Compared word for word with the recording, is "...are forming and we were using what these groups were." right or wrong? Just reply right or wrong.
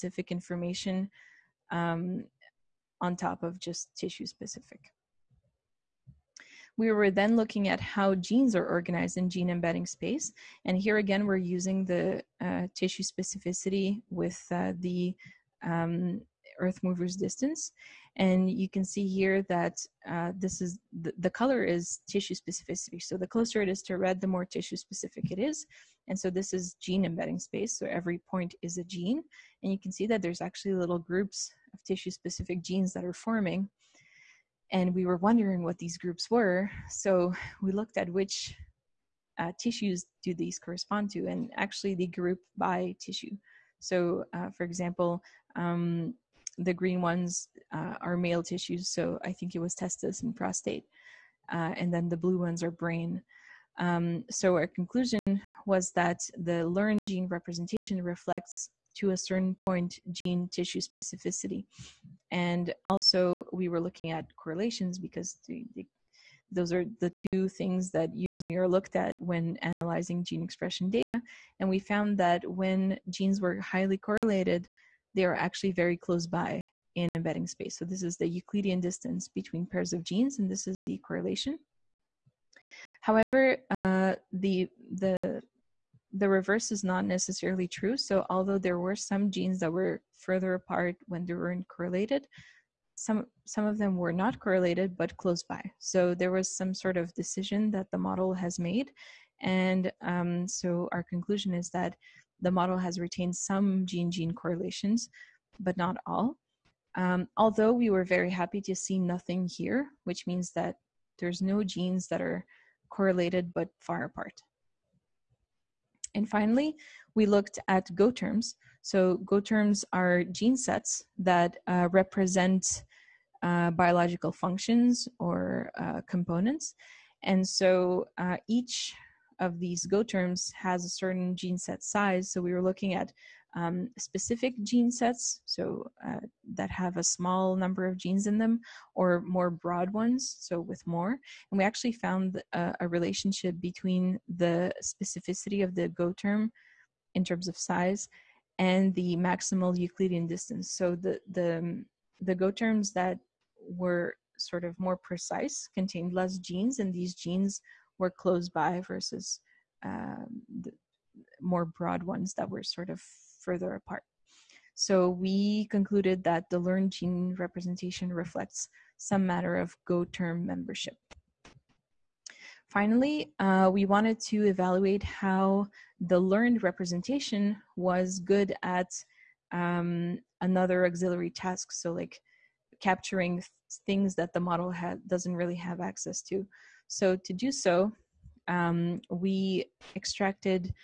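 wrong.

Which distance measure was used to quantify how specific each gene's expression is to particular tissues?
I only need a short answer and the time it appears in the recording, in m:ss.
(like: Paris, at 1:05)
Earth mover's distance, at 0:16.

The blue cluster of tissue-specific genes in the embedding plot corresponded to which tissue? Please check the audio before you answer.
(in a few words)
Brain.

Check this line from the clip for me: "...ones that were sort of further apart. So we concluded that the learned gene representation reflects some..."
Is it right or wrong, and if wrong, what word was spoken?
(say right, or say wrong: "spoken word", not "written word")
right.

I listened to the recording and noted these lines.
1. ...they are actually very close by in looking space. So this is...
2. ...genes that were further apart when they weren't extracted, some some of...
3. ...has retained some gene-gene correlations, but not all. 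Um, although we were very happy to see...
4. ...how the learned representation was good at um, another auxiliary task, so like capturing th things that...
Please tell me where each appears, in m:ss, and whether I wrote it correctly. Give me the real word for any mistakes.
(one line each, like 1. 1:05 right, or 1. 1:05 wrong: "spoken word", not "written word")
1. 1:15 wrong: "embedding", not "looking"
2. 1:29 wrong: "correlated", not "extracted"
3. 1:42 right
4. 2:55 right.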